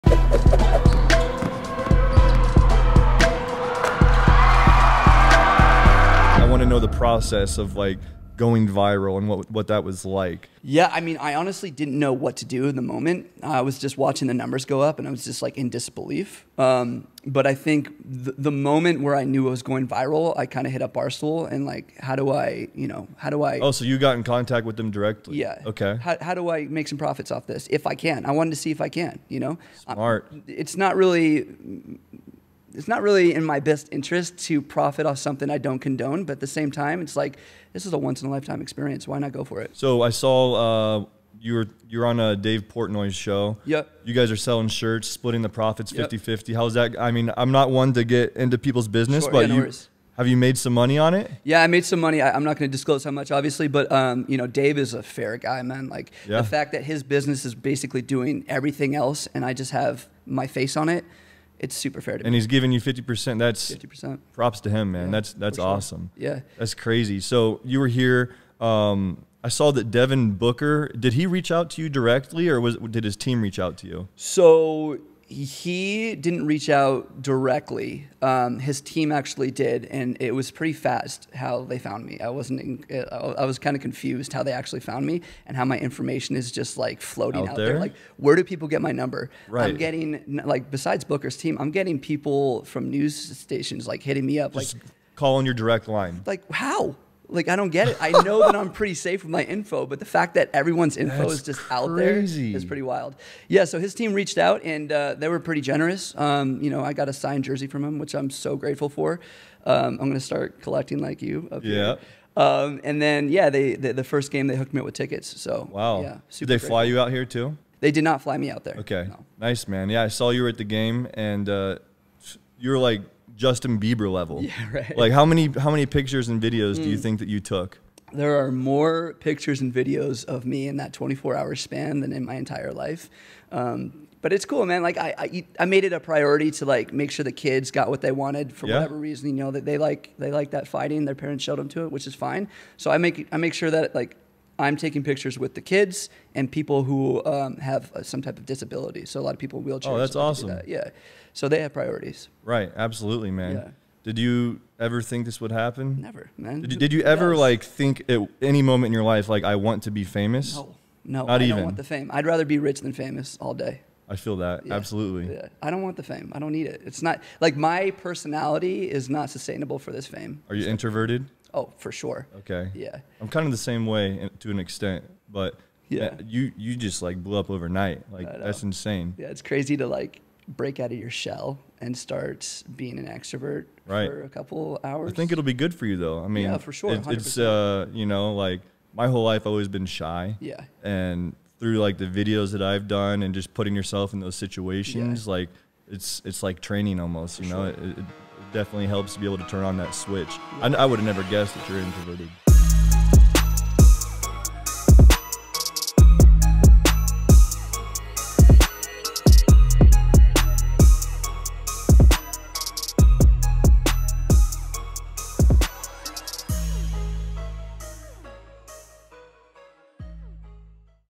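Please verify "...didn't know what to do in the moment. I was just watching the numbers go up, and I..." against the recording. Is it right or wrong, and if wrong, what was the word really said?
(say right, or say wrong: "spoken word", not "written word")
right.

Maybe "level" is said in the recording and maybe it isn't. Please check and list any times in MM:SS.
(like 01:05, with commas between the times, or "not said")
02:04.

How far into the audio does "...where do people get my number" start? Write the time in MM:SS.
01:28.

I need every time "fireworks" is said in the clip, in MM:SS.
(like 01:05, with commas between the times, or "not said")
not said.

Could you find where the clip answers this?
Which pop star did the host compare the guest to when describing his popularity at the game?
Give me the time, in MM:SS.
02:03.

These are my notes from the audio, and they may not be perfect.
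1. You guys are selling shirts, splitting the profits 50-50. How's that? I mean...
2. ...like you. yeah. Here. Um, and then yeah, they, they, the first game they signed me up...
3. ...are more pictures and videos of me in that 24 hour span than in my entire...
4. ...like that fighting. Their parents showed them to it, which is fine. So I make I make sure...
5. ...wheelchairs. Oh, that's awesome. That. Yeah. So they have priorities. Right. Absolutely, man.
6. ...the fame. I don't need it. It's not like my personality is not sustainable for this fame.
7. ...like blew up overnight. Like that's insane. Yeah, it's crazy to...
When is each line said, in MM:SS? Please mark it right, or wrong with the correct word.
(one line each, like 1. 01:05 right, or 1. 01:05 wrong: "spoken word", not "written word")
1. 00:44 right
2. 01:50 wrong: "hooked", not "signed"
3. 02:08 right
4. 02:20 right
5. 02:29 right
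6. 02:45 right
7. 02:57 right.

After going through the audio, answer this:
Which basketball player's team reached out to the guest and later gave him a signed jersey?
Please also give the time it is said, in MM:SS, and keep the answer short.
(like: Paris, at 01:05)
Devin Booker, at 01:09.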